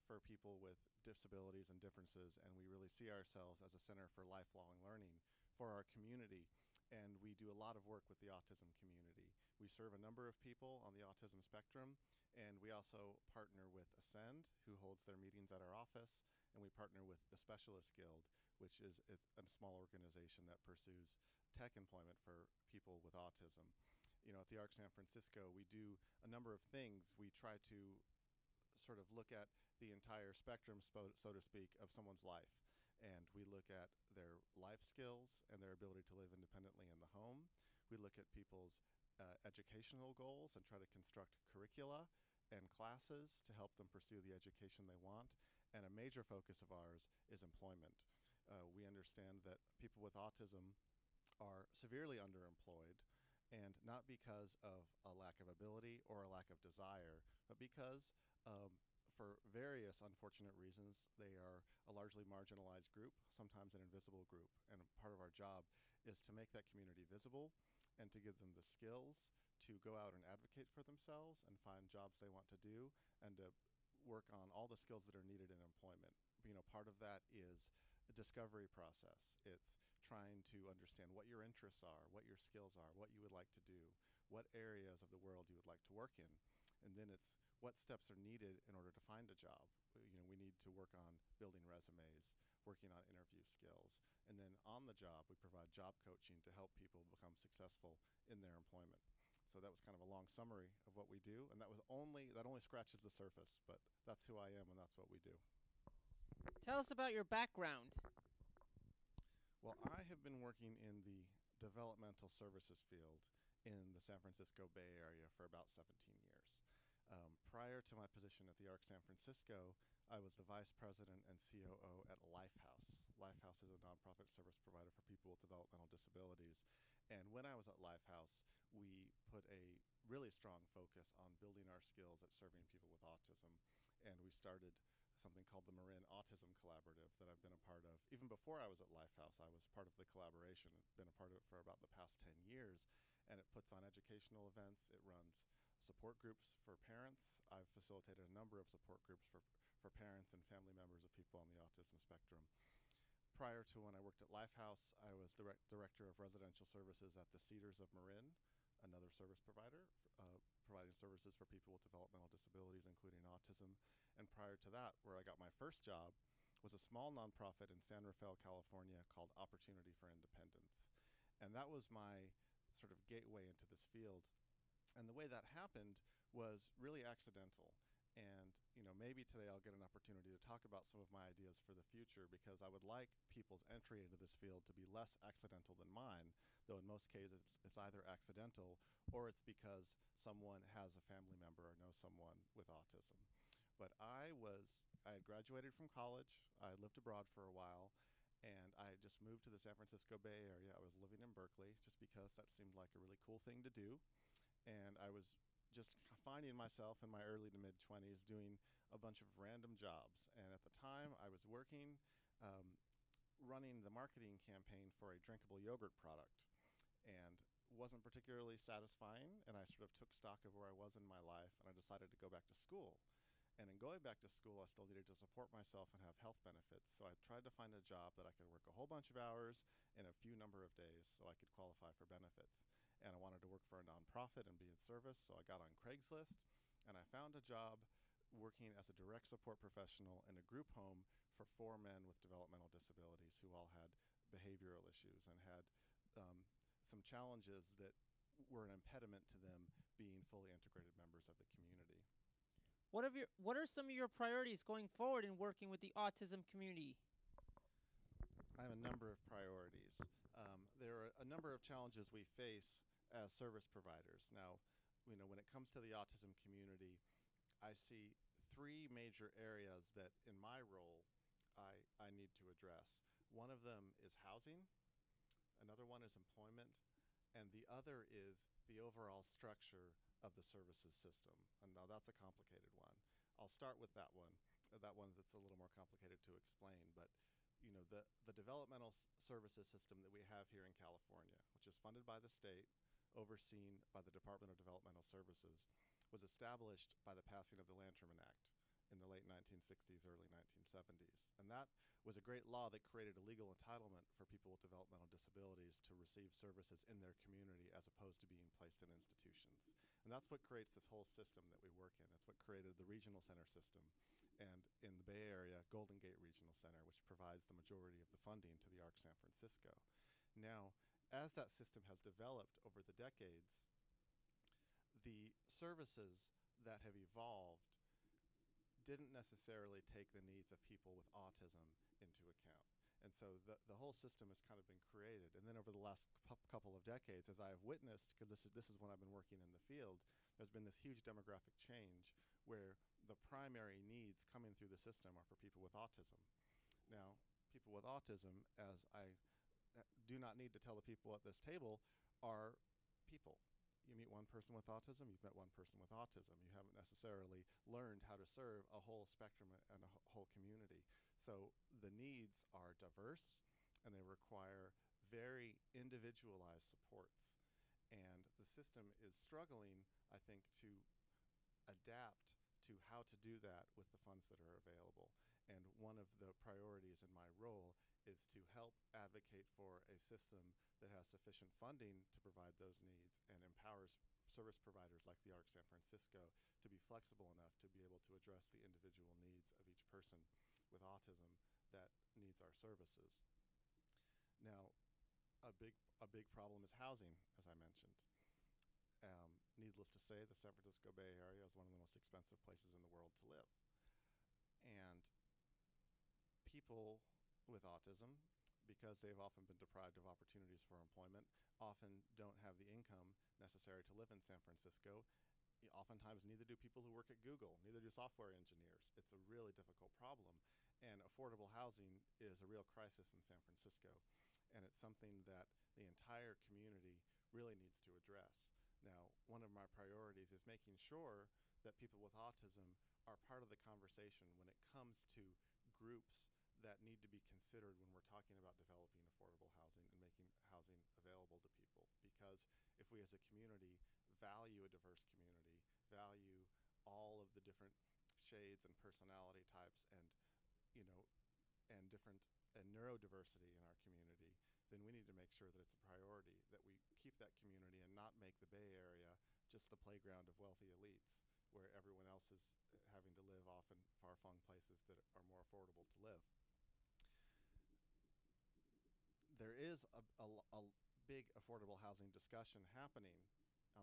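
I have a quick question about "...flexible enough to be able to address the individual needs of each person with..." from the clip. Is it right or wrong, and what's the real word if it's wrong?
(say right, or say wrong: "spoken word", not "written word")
right.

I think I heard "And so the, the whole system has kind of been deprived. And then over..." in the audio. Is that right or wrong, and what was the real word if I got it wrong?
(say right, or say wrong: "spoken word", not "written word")
wrong: "created", not "deprived".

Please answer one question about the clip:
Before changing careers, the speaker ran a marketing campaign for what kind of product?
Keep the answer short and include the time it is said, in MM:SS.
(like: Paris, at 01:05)
Drinkable yogurt, at 03:35.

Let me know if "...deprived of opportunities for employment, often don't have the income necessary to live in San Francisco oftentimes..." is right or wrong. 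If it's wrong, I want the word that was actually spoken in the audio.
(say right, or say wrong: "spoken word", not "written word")
right.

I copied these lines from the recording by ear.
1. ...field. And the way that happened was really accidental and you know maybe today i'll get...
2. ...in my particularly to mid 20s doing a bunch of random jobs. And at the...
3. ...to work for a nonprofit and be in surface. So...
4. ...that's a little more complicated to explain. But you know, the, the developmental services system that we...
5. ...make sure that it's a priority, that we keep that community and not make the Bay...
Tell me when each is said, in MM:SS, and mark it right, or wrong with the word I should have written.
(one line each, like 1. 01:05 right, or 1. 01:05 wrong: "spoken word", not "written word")
1. 02:53 right
2. 03:27 wrong: "early", not "particularly"
3. 03:53 wrong: "service", not "surface"
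4. 04:45 right
5. 07:35 right.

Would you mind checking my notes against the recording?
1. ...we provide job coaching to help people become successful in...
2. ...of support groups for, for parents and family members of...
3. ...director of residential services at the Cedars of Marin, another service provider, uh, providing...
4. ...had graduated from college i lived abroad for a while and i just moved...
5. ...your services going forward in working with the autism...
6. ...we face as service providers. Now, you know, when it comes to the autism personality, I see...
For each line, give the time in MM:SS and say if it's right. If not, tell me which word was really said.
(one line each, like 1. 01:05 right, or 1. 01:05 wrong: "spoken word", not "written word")
1. 01:35 right
2. 02:28 right
3. 02:35 right
4. 03:15 right
5. 04:13 wrong: "priorities", not "services"
6. 04:22 wrong: "community", not "personality".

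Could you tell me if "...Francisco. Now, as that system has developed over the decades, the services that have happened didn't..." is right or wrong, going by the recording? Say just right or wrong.
wrong.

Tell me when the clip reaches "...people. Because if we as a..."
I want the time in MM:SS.
07:21.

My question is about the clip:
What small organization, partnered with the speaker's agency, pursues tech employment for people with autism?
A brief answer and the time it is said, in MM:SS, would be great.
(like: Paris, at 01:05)
Specialist Guild, at 00:17.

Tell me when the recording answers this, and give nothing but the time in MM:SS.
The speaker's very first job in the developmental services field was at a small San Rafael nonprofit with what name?
02:49.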